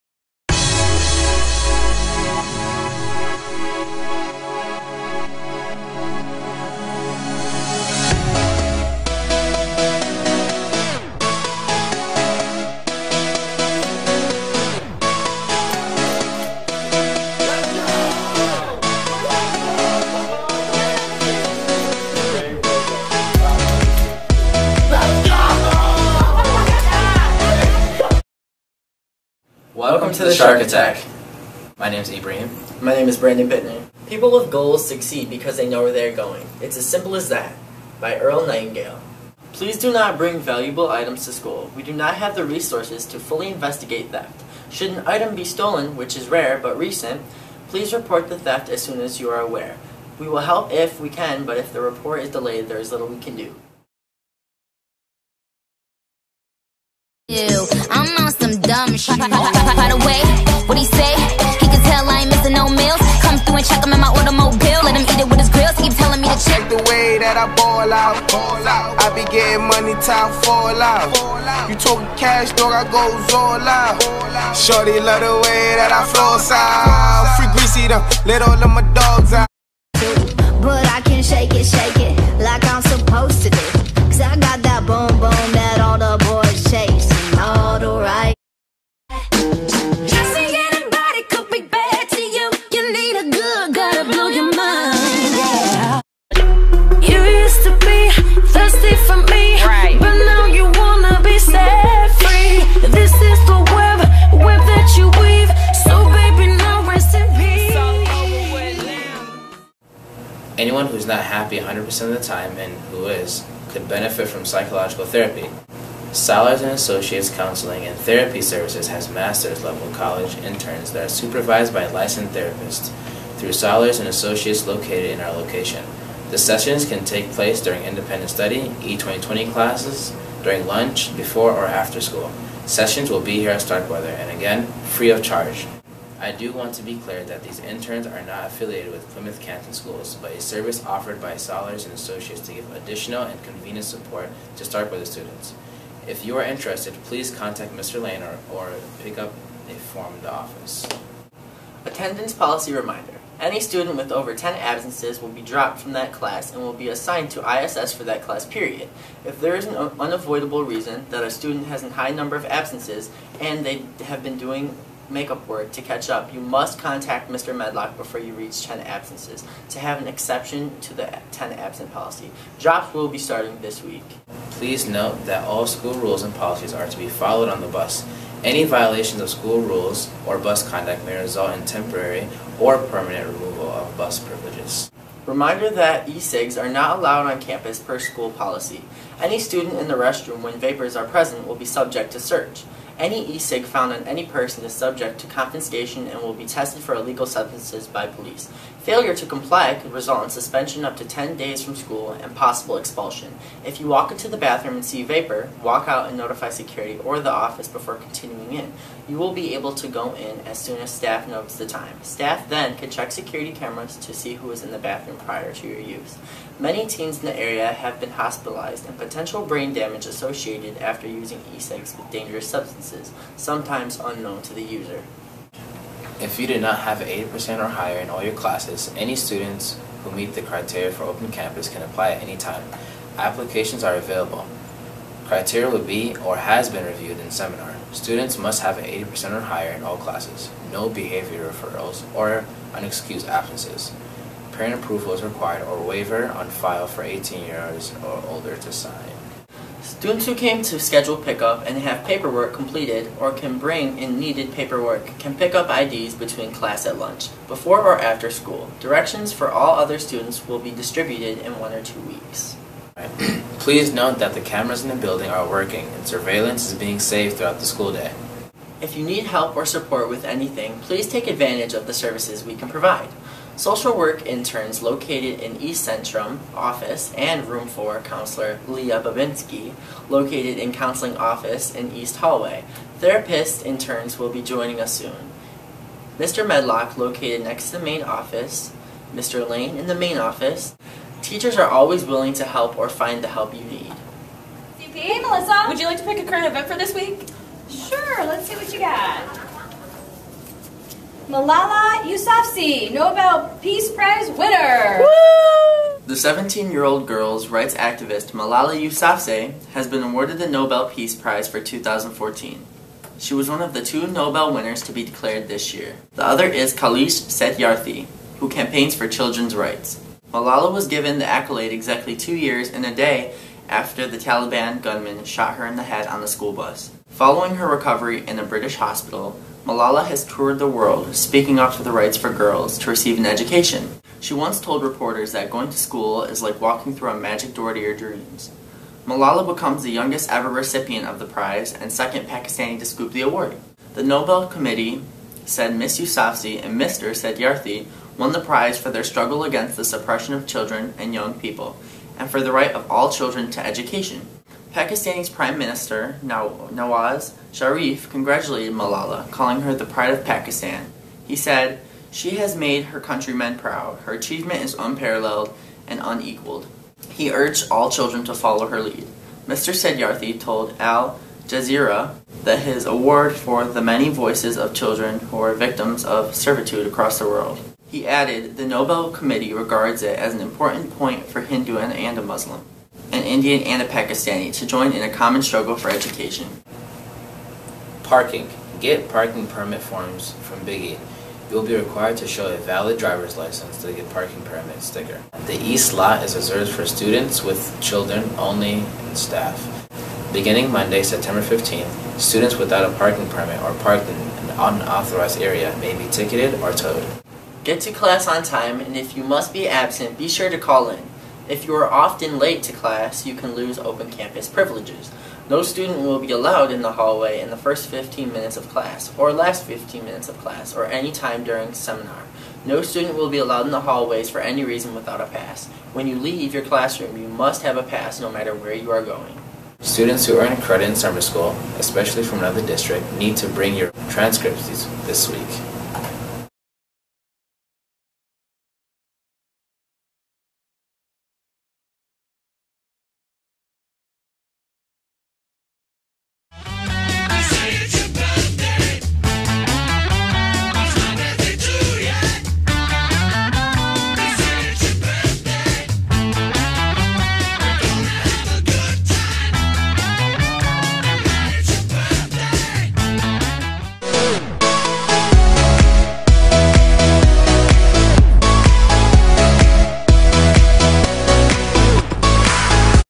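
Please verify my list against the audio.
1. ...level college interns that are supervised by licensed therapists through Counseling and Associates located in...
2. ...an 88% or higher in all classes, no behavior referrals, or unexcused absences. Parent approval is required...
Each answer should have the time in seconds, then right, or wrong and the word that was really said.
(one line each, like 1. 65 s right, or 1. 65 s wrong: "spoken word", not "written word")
1. 119 s wrong: "Scholars", not "Counseling"
2. 238 s wrong: "80", not "88".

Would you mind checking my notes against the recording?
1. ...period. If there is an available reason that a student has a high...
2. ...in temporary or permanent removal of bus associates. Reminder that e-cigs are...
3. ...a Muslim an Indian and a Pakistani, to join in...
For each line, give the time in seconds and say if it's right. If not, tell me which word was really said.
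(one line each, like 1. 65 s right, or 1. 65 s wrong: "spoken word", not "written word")
1. 158 s wrong: "unavoidable", not "available"
2. 181 s wrong: "privileges", not "associates"
3. 382 s right.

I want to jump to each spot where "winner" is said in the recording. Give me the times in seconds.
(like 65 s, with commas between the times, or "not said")
304 s, 314 s.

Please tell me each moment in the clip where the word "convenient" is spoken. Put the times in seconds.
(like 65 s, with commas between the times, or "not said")
143 s.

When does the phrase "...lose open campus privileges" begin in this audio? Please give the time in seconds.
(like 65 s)
413 s.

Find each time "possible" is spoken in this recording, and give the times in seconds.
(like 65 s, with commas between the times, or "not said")
202 s.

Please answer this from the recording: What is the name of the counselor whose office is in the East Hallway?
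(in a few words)
Leah Babinski.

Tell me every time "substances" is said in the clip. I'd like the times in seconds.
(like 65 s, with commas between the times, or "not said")
197 s, 222 s.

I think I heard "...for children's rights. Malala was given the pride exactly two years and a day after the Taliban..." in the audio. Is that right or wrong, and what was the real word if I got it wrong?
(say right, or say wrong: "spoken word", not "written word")
wrong: "accolade", not "pride".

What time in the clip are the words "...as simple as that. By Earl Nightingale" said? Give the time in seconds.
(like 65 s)
36 s.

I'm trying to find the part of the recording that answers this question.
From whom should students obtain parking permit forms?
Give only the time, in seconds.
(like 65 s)
390 s.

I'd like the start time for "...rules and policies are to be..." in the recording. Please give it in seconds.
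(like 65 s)
175 s.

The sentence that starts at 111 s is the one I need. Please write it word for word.
who's not happy 100% of the time and who is could benefit from psychological therapy.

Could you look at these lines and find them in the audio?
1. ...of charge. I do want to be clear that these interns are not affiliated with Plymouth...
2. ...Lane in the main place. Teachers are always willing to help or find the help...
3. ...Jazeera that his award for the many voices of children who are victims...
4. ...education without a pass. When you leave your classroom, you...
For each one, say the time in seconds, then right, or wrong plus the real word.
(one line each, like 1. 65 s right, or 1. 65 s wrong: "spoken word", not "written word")
1. 135 s right
2. 289 s wrong: "office", not "place"
3. 371 s right
4. 424 s wrong: "reason", not "education".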